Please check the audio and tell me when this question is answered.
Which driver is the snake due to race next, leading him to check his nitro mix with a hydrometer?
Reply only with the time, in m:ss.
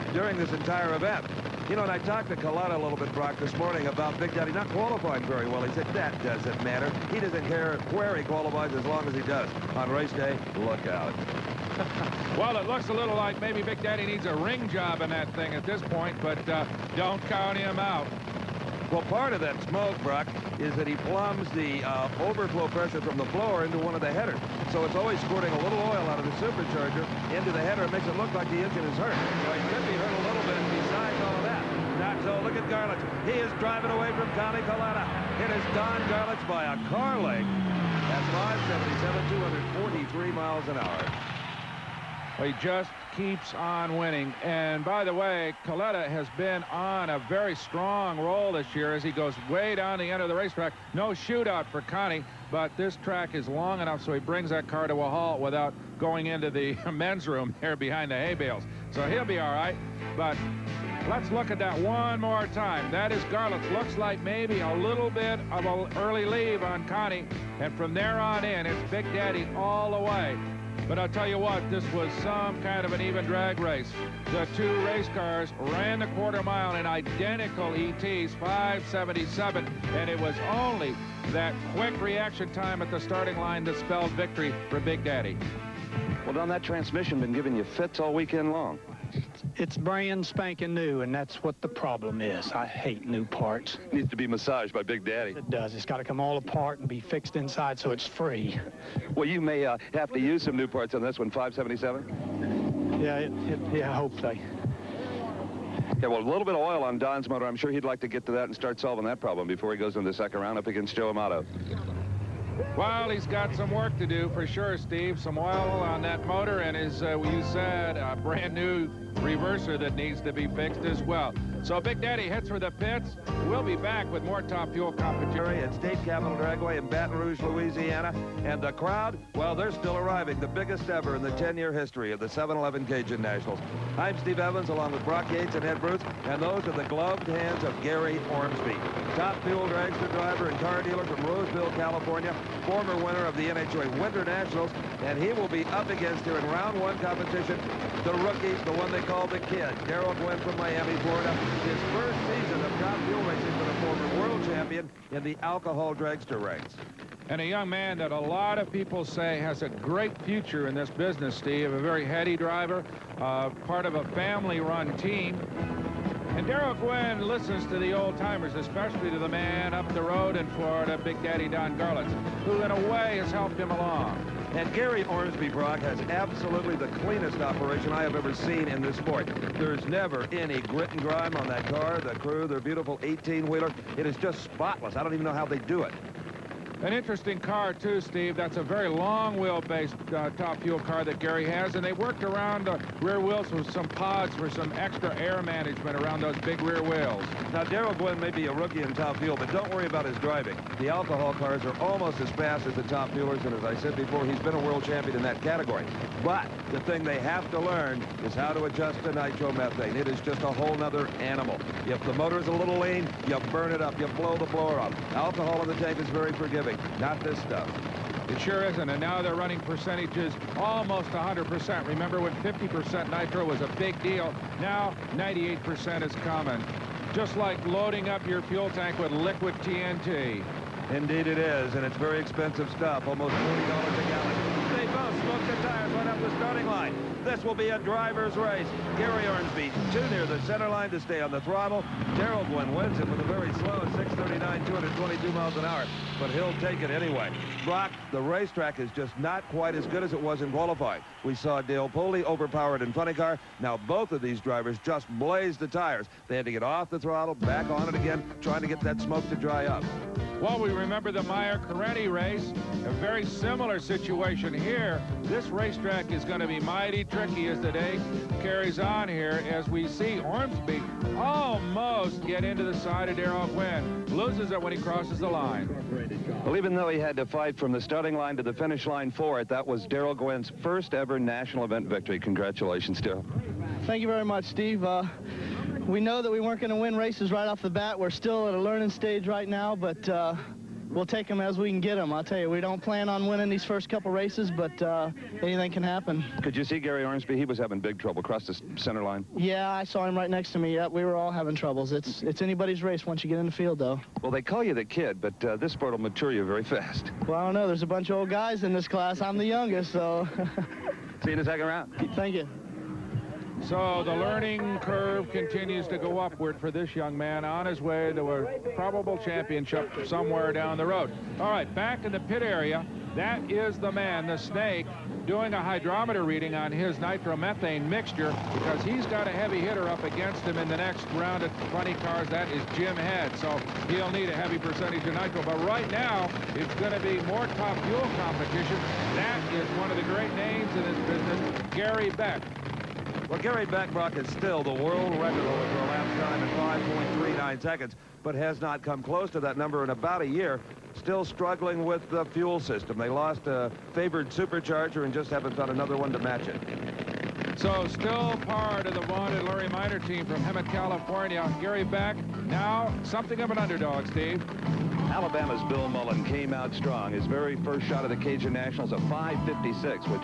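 5:32.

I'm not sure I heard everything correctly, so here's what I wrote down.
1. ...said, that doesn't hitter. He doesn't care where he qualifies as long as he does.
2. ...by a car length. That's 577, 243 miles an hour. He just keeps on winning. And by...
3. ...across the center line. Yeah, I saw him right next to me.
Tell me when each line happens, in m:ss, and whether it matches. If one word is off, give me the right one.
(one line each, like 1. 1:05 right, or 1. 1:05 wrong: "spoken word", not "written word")
1. 0:05 wrong: "matter", not "hitter"
2. 0:36 right
3. 4:58 right.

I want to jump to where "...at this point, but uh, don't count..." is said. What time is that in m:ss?
0:15.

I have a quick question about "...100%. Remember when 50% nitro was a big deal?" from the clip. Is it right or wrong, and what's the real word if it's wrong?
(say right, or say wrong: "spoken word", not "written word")
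right.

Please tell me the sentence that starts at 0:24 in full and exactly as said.
So it's always squirting a little oil out of the supercharger into the header.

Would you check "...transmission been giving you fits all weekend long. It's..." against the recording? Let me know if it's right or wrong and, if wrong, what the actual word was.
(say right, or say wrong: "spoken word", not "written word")
right.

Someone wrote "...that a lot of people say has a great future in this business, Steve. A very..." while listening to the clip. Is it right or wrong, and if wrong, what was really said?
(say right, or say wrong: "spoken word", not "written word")
right.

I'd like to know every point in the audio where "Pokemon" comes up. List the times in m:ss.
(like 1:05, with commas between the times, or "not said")
not said.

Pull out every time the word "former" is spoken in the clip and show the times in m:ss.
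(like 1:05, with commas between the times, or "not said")
2:22, 2:33.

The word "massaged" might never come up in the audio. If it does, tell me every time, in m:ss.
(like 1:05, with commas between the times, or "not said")
1:34.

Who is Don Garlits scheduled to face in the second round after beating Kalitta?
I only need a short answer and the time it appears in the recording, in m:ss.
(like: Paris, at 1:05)
Joe Amato, at 1:50.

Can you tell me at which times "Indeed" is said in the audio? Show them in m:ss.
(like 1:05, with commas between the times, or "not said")
3:50.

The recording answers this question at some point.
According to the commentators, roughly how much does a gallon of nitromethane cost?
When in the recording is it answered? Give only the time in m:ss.
3:53.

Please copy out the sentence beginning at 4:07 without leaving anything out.
Brock, the racetrack is just not quite as good as it was in qualifying.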